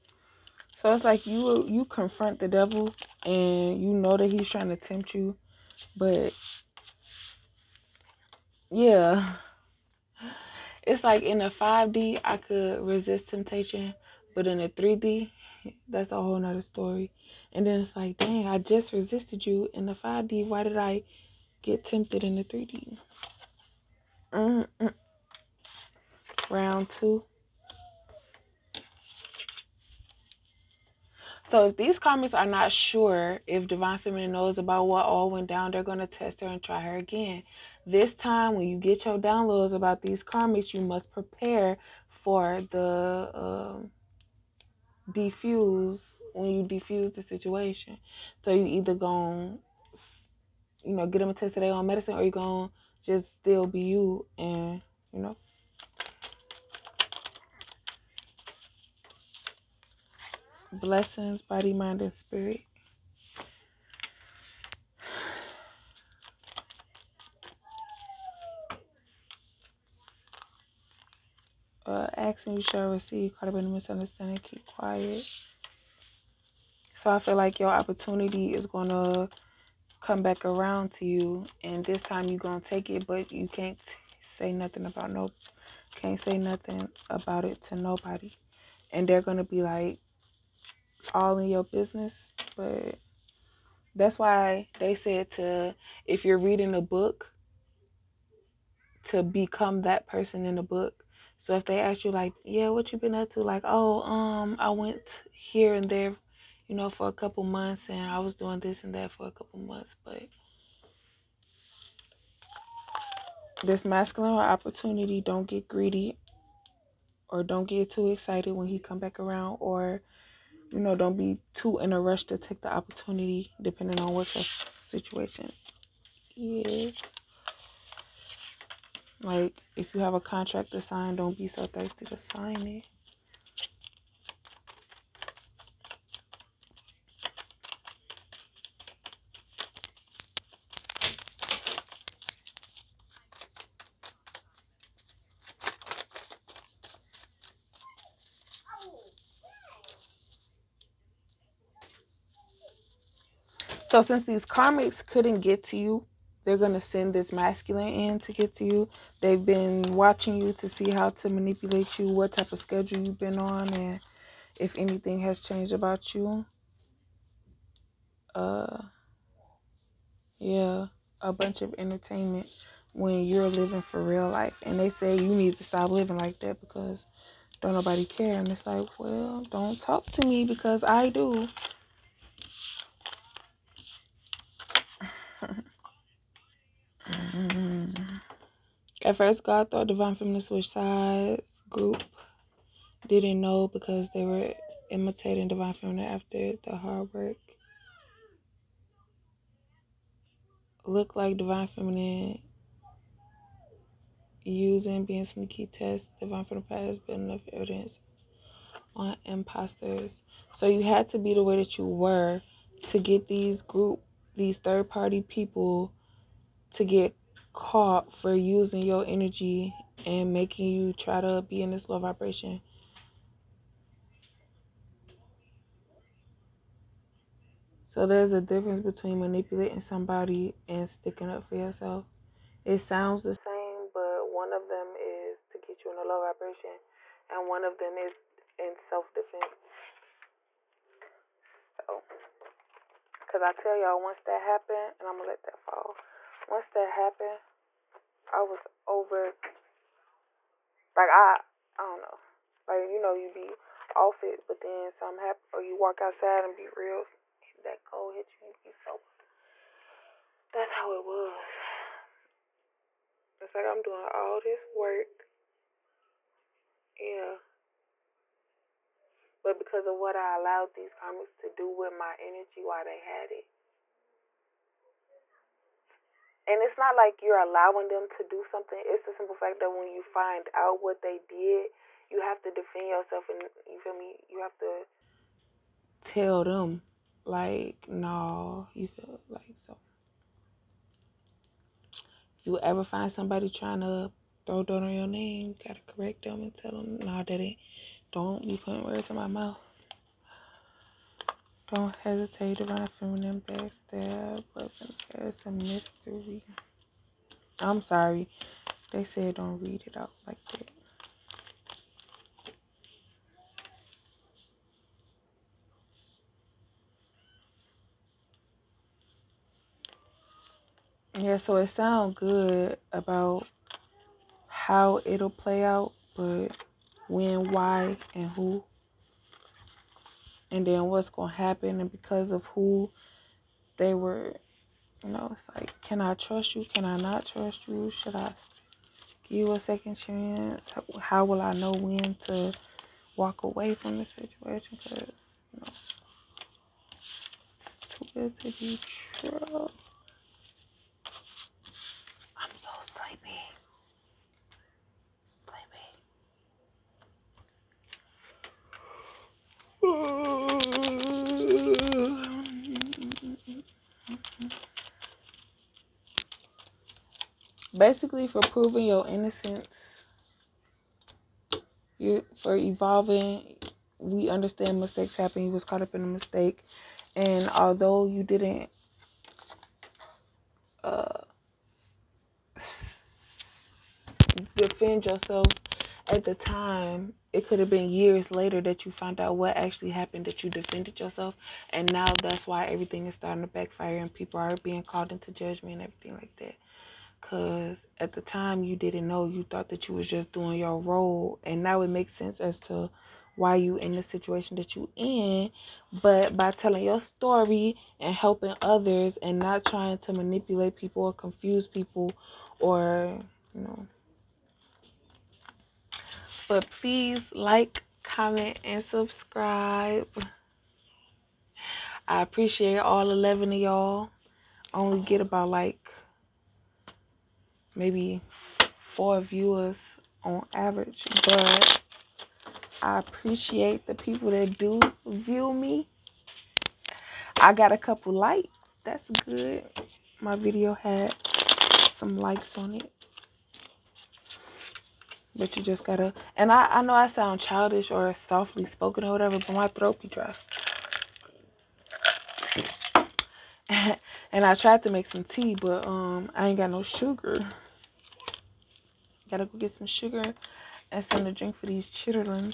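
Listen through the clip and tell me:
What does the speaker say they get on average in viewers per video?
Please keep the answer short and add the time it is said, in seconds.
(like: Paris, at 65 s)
4, at 428 s.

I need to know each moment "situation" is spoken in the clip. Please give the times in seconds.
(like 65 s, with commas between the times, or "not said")
47 s, 124 s, 344 s, 404 s.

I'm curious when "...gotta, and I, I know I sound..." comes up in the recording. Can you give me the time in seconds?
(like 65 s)
445 s.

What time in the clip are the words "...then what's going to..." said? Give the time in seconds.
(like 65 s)
330 s.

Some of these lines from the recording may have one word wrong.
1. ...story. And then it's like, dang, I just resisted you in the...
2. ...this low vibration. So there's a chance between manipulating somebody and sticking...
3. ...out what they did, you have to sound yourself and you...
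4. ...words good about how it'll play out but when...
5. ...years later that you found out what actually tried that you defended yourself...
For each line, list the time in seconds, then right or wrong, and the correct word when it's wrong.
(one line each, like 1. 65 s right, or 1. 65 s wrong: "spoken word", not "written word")
1. 16 s right
2. 221 s wrong: "difference", not "chance"
3. 280 s wrong: "defend", not "sound"
4. 321 s wrong: "sounds", not "words"
5. 387 s wrong: "happened", not "tried".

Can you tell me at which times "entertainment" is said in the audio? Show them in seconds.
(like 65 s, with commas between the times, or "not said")
171 s.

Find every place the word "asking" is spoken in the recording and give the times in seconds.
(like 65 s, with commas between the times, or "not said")
72 s.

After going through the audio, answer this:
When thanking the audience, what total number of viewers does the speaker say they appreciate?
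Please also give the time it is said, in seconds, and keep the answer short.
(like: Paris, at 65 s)
11, at 423 s.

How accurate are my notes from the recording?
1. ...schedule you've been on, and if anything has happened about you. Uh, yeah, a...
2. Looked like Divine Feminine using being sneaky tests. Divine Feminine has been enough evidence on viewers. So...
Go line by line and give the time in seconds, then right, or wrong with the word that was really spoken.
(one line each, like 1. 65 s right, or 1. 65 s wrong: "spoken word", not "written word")
1. 162 s wrong: "changed", not "happened"
2. 200 s wrong: "imposters", not "viewers".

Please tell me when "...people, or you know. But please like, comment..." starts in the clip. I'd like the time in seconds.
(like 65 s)
411 s.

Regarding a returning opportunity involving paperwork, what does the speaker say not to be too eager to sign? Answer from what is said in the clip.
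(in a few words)
A contract.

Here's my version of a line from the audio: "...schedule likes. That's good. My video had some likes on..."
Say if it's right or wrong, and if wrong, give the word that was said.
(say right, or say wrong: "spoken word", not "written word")
wrong: "couple", not "schedule".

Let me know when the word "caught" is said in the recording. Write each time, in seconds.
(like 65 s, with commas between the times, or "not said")
73 s, 217 s, 375 s.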